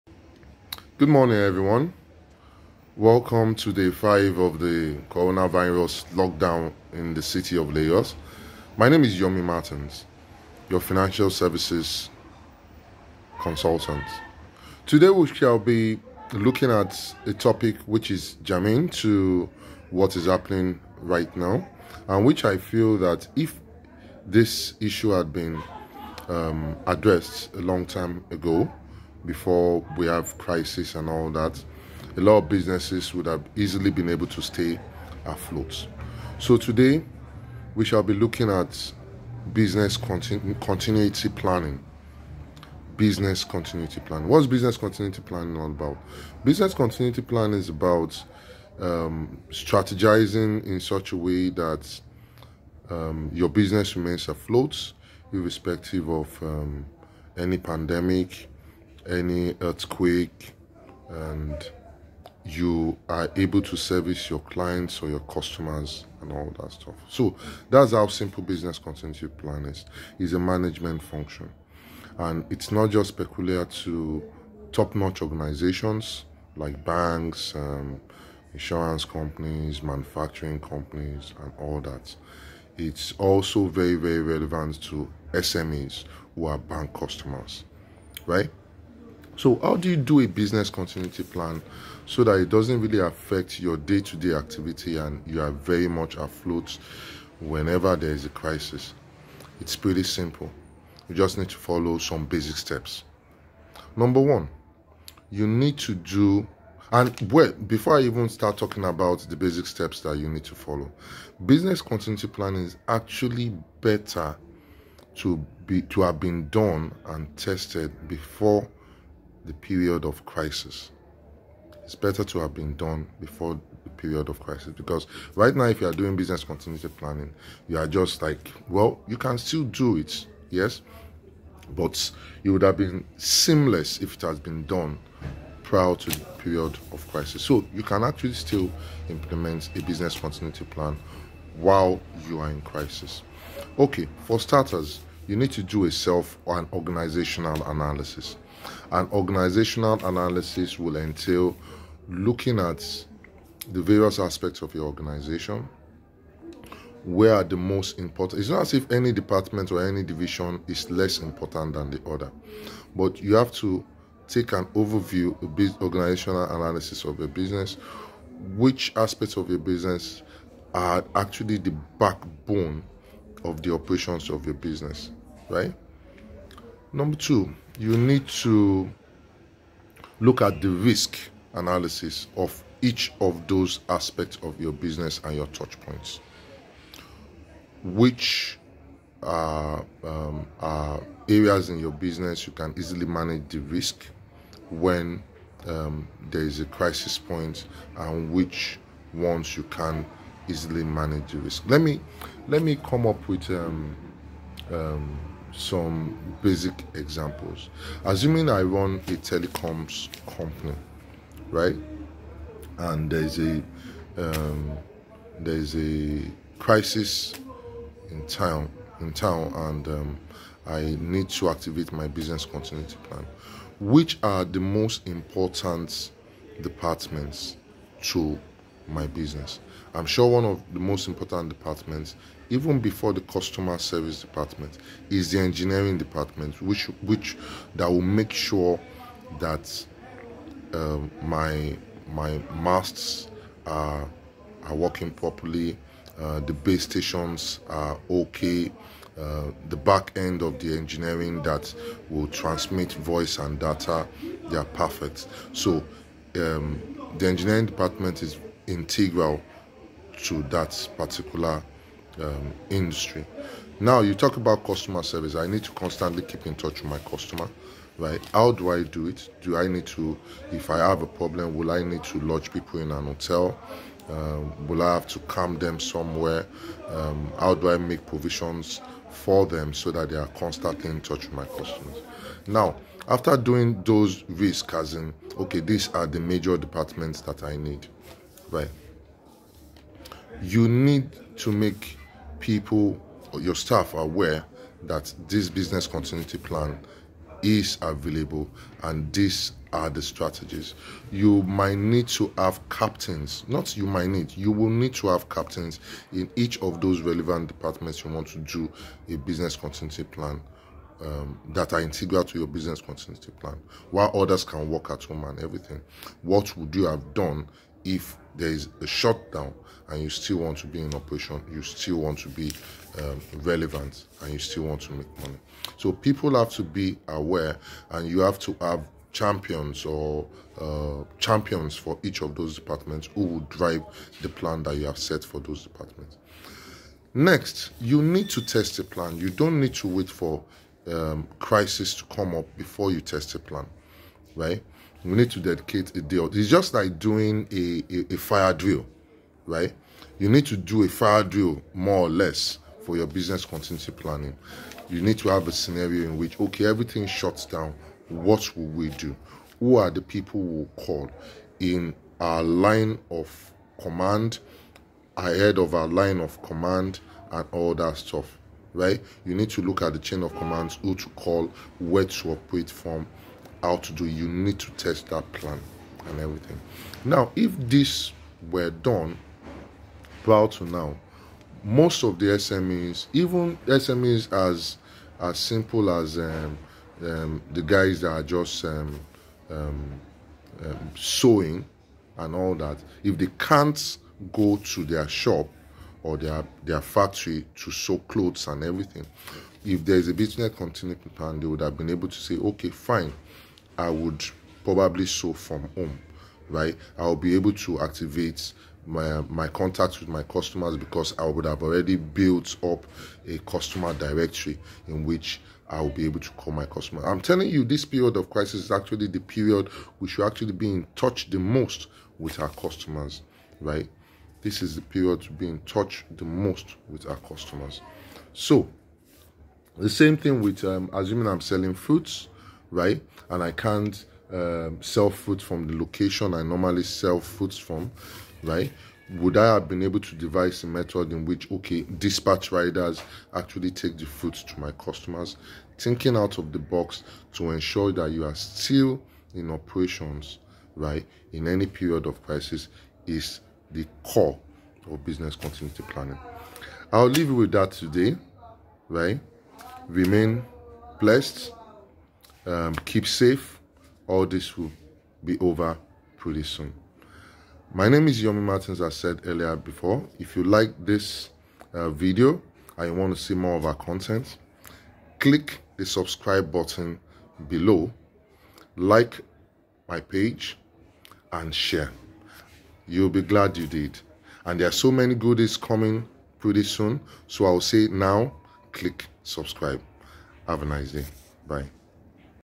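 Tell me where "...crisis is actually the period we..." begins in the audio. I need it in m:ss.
6:58.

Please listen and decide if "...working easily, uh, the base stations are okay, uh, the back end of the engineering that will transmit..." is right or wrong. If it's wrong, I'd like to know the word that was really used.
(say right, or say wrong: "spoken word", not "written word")
wrong: "properly", not "easily".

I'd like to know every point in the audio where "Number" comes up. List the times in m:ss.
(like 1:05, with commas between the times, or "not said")
1:43, 2:56.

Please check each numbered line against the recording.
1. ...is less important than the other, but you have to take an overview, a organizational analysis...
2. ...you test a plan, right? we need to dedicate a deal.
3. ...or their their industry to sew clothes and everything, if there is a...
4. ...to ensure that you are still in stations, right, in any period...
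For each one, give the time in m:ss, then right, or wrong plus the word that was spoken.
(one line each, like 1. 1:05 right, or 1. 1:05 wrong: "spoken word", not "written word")
1. 2:40 right
2. 5:42 right
3. 6:36 wrong: "factory", not "industry"
4. 7:27 wrong: "operations", not "stations".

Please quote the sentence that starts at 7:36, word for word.
I'll leave you with that today, right?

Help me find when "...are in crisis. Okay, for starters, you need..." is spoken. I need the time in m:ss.
2:22.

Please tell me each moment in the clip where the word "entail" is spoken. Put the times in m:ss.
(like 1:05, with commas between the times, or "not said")
2:30.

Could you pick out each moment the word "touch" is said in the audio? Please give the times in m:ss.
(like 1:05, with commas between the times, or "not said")
3:05, 4:26, 4:41, 7:00, 7:05.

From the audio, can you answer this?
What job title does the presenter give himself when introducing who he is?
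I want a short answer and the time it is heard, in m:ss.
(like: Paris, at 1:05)
Financial services consultant, at 0:10.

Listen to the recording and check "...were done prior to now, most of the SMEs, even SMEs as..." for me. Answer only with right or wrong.
right.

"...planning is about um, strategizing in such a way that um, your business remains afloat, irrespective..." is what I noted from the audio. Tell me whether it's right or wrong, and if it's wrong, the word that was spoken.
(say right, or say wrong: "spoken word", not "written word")
right.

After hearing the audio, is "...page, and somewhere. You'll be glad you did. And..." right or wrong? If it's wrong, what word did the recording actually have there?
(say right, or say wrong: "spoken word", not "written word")
wrong: "share", not "somewhere".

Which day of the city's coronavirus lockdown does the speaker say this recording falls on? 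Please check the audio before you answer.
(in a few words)
Day five.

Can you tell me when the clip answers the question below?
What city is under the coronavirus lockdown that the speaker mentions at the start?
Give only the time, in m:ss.
0:07.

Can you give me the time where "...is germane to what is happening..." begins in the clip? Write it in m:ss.
0:18.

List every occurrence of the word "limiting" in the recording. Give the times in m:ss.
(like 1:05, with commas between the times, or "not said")
not said.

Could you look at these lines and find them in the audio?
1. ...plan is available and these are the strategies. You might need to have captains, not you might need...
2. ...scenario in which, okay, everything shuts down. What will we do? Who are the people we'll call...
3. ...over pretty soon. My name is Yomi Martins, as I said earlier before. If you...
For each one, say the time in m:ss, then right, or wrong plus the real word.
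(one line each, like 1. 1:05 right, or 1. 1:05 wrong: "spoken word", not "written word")
1. 4:56 right
2. 5:55 right
3. 7:45 right.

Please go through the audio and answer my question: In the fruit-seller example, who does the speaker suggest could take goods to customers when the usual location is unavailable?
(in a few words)
Dispatch riders.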